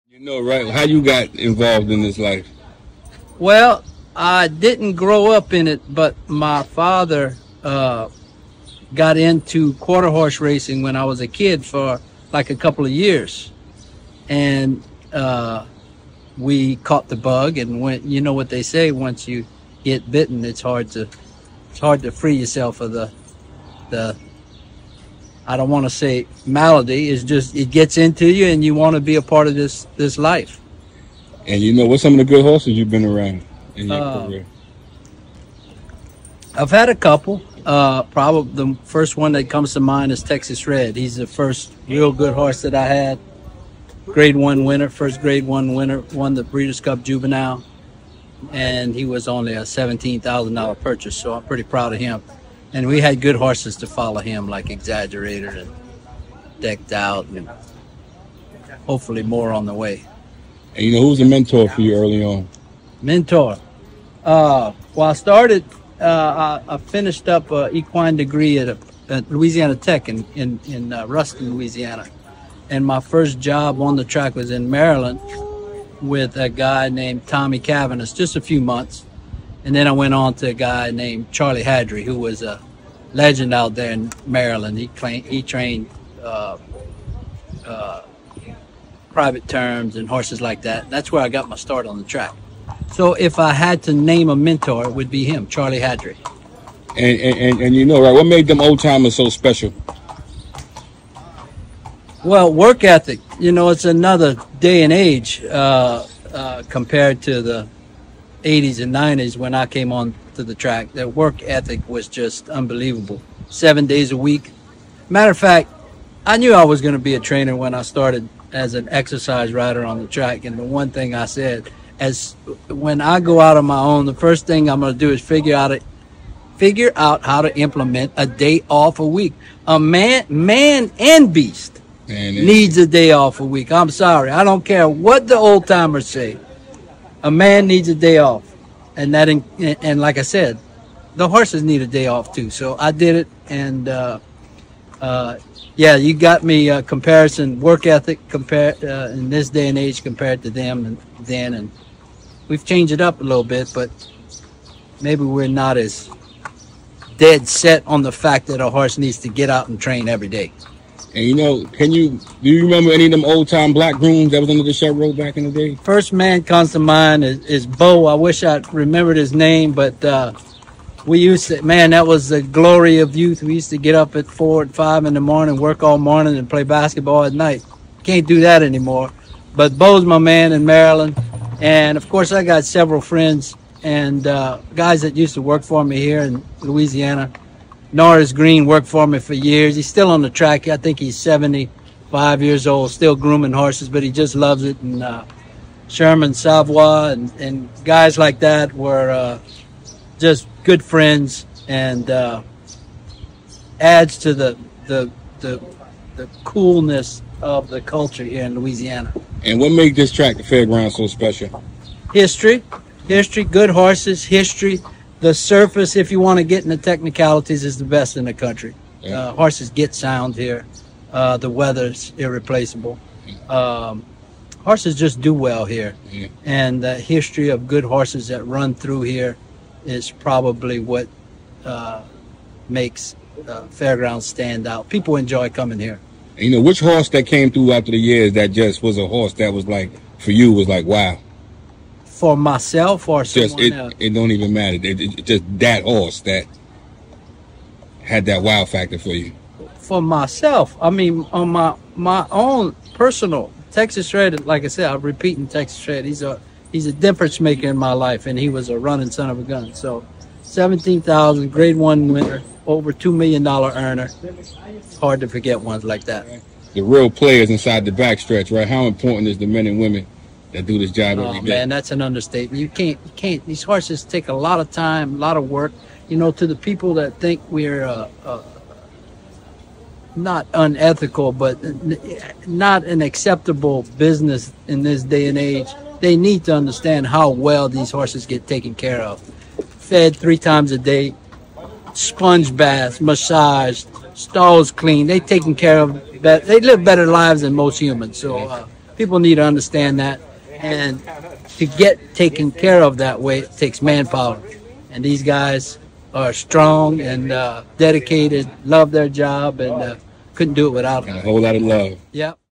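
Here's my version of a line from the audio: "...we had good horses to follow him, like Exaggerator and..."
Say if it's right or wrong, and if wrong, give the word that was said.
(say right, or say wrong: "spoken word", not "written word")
right.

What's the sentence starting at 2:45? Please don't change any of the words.
First man comes to mind is, is Bo.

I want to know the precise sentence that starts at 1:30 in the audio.
That's where I got my start on the track.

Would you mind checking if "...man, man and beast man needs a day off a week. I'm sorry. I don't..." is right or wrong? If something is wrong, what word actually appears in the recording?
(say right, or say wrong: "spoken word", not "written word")
right.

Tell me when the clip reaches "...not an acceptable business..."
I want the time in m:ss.
4:42.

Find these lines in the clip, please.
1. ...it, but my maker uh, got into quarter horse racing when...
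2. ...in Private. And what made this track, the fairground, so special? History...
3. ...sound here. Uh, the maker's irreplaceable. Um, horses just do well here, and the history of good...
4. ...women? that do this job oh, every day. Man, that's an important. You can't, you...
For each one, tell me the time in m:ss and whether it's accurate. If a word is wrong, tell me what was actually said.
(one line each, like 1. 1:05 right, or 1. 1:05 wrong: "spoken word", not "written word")
1. 0:05 wrong: "father", not "maker"
2. 3:28 wrong: "Louisiana", not "Private"
3. 3:39 wrong: "weather", not "maker"
4. 4:29 wrong: "understatement", not "important".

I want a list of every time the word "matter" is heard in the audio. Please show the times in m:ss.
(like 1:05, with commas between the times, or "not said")
1:55, 4:04.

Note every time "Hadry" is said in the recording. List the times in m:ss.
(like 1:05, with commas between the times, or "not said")
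1:21, 1:35.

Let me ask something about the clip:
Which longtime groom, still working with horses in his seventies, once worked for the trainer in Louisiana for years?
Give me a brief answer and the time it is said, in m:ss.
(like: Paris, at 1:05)
Norris Green, at 3:07.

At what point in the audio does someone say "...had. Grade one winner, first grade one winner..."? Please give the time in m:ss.
0:42.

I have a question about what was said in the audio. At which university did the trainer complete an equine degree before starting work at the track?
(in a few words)
Louisiana Tech.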